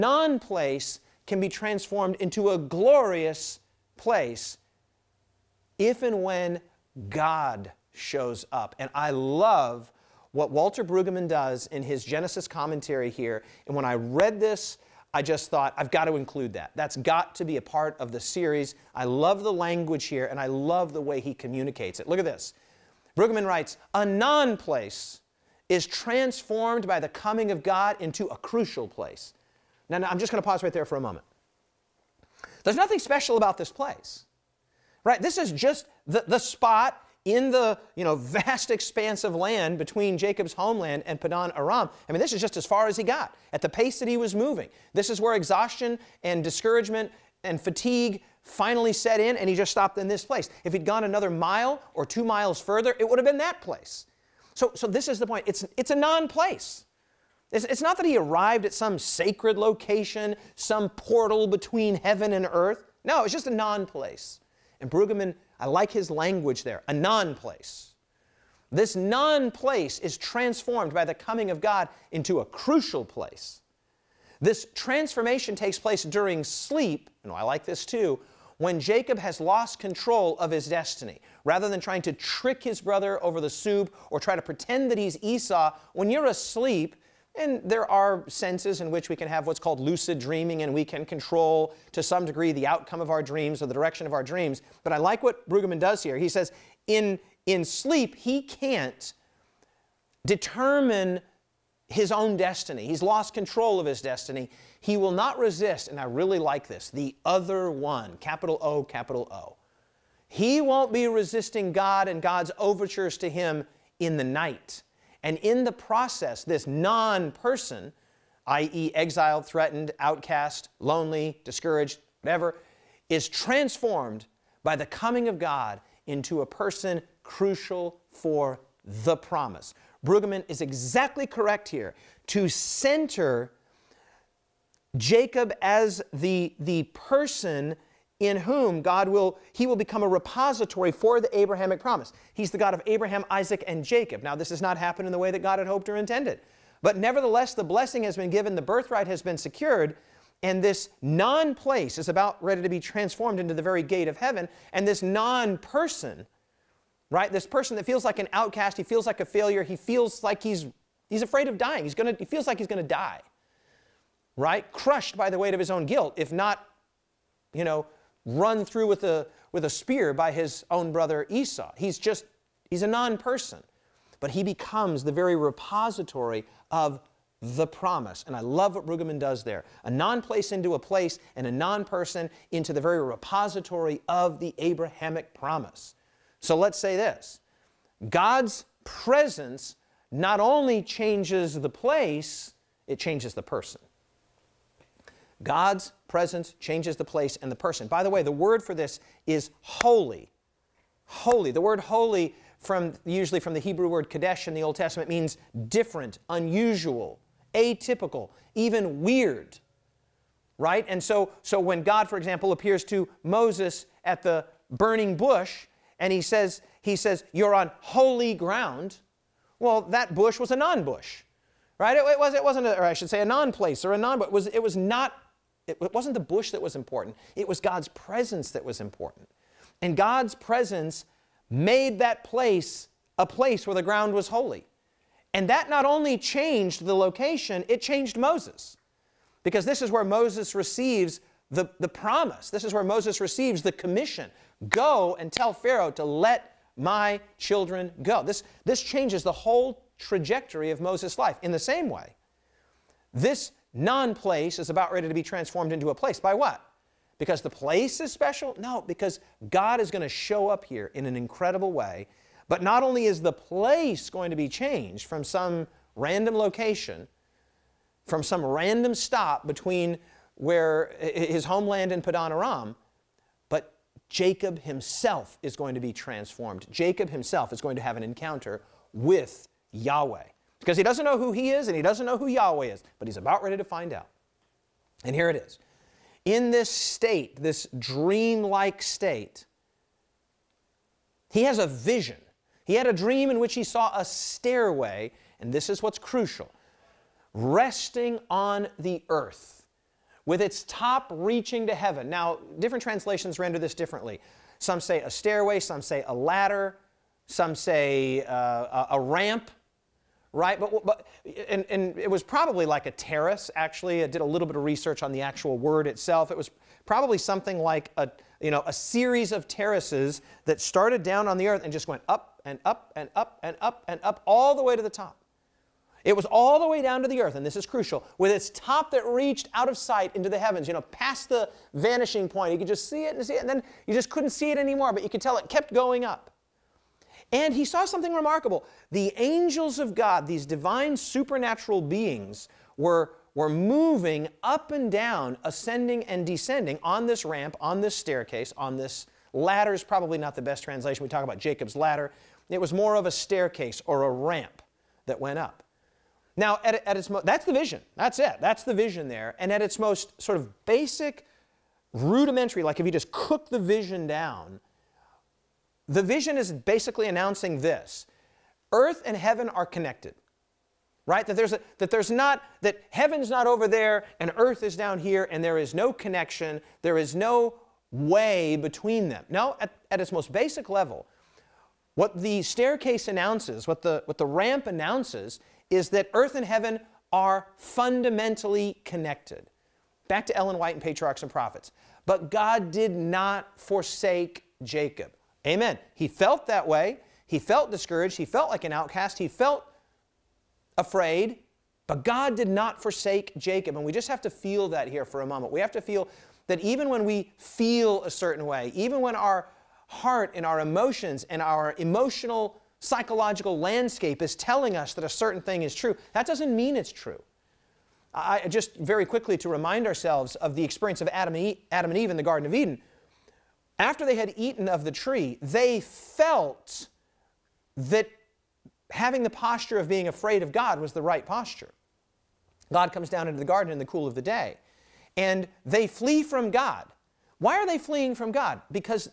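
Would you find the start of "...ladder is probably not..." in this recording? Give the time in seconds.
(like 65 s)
349 s.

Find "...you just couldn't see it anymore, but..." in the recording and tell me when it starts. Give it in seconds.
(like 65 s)
333 s.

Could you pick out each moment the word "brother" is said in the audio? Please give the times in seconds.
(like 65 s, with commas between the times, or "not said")
82 s, 170 s.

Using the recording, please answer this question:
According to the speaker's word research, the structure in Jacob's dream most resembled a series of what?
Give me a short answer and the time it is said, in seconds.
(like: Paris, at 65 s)
Terraces, at 319 s.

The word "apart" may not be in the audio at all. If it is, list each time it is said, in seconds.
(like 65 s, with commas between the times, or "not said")
not said.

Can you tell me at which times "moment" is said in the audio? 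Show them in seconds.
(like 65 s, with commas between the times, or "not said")
31 s, 405 s.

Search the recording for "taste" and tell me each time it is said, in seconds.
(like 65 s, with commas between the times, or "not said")
not said.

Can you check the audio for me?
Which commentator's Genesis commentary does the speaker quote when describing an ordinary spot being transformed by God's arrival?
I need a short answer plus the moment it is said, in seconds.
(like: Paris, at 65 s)
Walter Brueggemann, at 10 s.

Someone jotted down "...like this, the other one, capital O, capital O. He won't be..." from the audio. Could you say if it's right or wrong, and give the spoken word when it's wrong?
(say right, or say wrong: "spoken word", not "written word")
right.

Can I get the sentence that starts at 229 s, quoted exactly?
And God's presence made that place a place where the ground was holy.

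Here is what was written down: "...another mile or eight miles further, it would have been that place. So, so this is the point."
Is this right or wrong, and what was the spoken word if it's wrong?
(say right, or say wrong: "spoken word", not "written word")
wrong: "two", not "eight".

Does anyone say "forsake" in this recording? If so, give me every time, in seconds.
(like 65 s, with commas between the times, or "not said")
393 s, 402 s.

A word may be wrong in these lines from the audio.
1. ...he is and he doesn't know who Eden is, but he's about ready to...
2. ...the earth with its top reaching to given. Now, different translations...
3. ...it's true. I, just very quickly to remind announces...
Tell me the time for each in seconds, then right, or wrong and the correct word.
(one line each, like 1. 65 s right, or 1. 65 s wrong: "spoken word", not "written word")
1. 281 s wrong: "Yahweh", not "Eden"
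2. 298 s wrong: "heaven", not "given"
3. 416 s wrong: "ourselves", not "announces".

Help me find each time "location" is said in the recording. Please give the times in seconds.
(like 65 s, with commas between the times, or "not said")
59 s, 236 s, 266 s.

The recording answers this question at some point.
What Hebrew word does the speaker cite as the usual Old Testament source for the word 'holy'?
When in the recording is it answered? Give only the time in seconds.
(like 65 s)
204 s.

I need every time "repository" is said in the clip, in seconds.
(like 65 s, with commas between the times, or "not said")
140 s, 175 s, 183 s.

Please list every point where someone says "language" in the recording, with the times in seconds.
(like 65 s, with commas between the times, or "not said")
19 s, 66 s.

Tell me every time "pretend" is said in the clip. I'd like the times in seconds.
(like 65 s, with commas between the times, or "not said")
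84 s.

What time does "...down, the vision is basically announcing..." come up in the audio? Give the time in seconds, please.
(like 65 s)
364 s.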